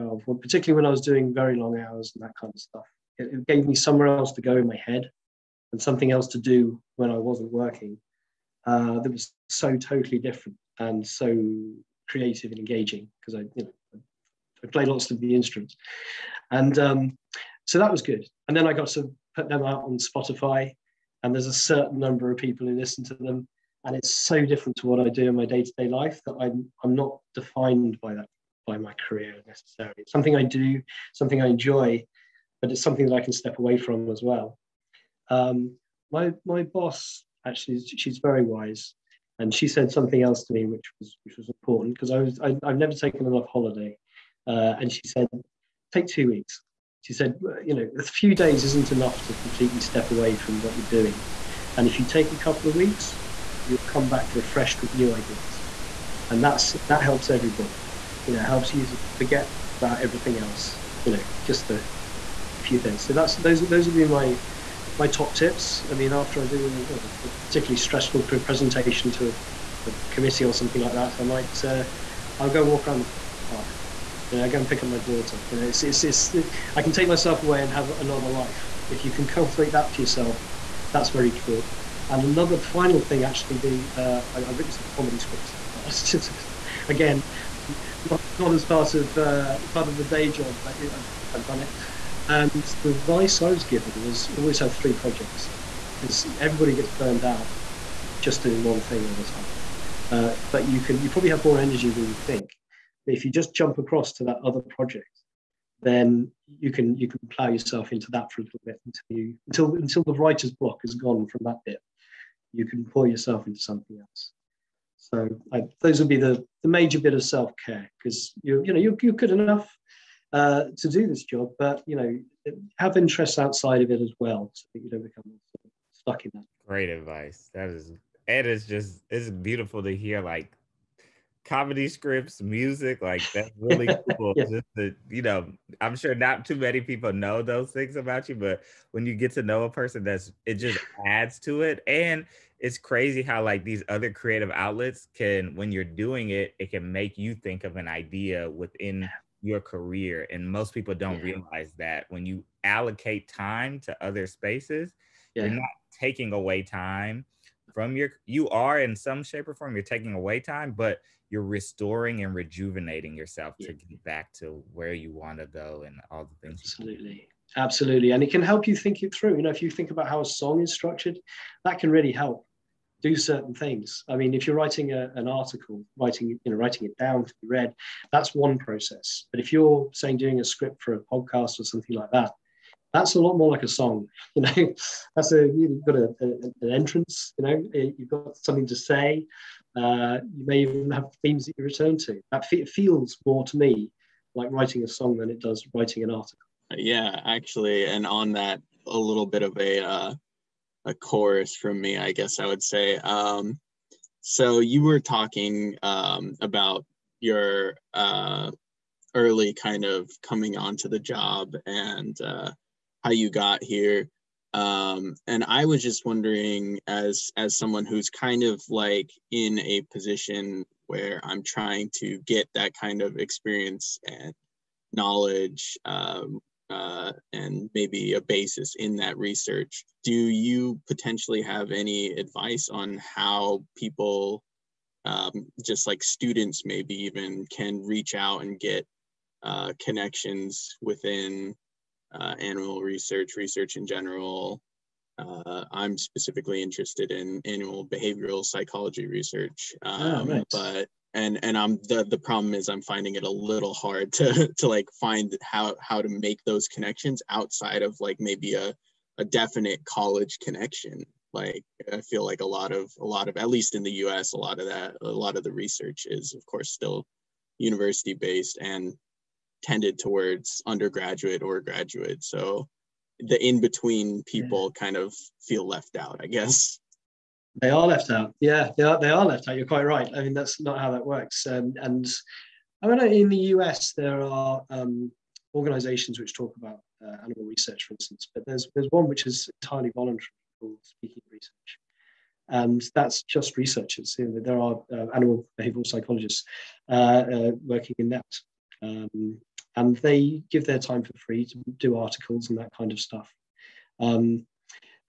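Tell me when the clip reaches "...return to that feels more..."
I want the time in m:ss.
3:11.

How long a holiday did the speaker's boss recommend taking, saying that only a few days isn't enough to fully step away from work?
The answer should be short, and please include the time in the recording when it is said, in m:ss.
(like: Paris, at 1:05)
2 weeks, at 0:46.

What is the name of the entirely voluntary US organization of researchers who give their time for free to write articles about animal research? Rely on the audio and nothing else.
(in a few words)
Speaking Research.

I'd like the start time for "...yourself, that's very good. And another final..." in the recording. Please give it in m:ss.
1:20.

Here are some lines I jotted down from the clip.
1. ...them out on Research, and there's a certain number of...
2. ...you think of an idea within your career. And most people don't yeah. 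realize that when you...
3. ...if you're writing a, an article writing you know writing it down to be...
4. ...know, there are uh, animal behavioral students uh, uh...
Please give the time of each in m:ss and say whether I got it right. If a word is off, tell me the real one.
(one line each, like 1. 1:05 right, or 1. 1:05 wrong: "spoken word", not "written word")
1. 0:19 wrong: "Spotify", not "Research"
2. 2:27 right
3. 2:54 right
4. 4:54 wrong: "psychologists", not "students".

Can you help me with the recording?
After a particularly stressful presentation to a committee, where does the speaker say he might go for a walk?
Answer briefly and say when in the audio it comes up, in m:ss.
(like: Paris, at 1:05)
The park, at 1:13.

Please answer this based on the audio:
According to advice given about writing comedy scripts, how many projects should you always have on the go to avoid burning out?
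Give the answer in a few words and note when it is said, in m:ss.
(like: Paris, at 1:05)
3, at 1:34.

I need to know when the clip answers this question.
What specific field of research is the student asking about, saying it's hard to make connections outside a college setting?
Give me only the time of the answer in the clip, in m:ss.
4:07.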